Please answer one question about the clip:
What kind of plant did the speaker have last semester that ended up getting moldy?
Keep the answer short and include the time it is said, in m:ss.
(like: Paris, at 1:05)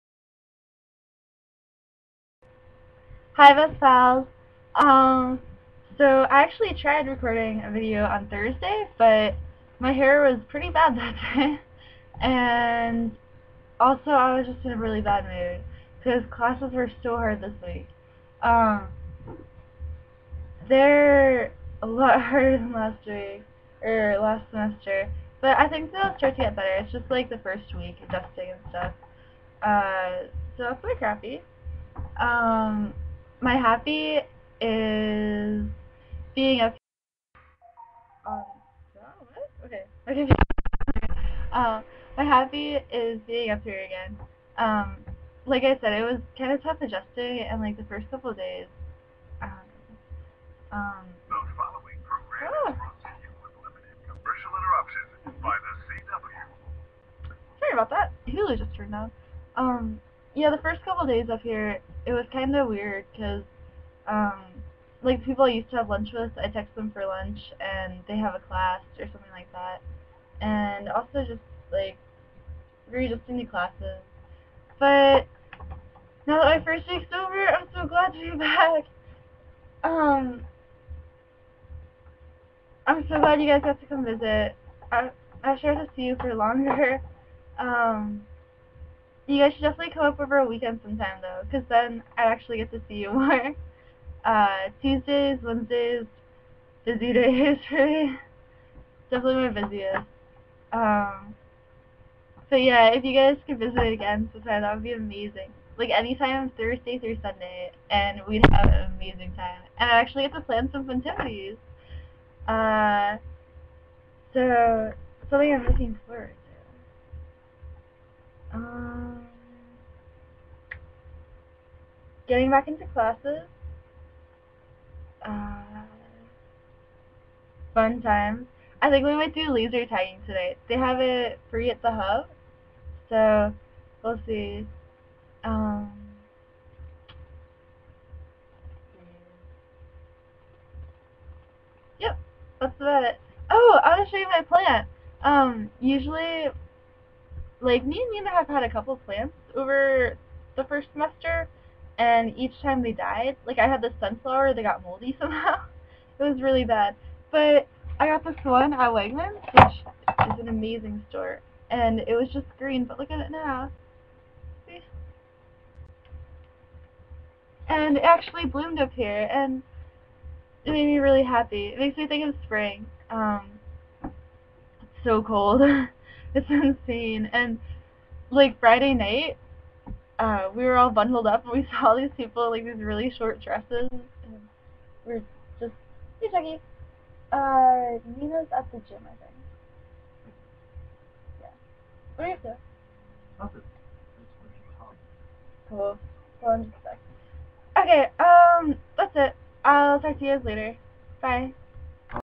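Sunflower, at 2:33.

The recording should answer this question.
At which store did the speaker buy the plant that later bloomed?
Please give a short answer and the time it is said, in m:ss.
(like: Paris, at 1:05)
Wegmans, at 2:38.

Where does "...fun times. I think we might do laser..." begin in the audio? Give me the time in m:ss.
2:07.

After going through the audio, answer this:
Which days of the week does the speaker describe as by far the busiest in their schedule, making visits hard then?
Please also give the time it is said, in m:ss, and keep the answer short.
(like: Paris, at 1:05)
Tuesdays, Wednesdays, at 1:34.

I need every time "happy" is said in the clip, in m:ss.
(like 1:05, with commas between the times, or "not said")
0:33, 0:42, 2:51.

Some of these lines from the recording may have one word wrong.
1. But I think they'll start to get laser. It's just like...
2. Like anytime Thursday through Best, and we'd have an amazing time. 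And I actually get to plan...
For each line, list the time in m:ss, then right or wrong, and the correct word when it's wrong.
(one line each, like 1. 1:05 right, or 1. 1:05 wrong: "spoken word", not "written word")
1. 0:25 wrong: "better", not "laser"
2. 1:45 wrong: "Sunday", not "Best".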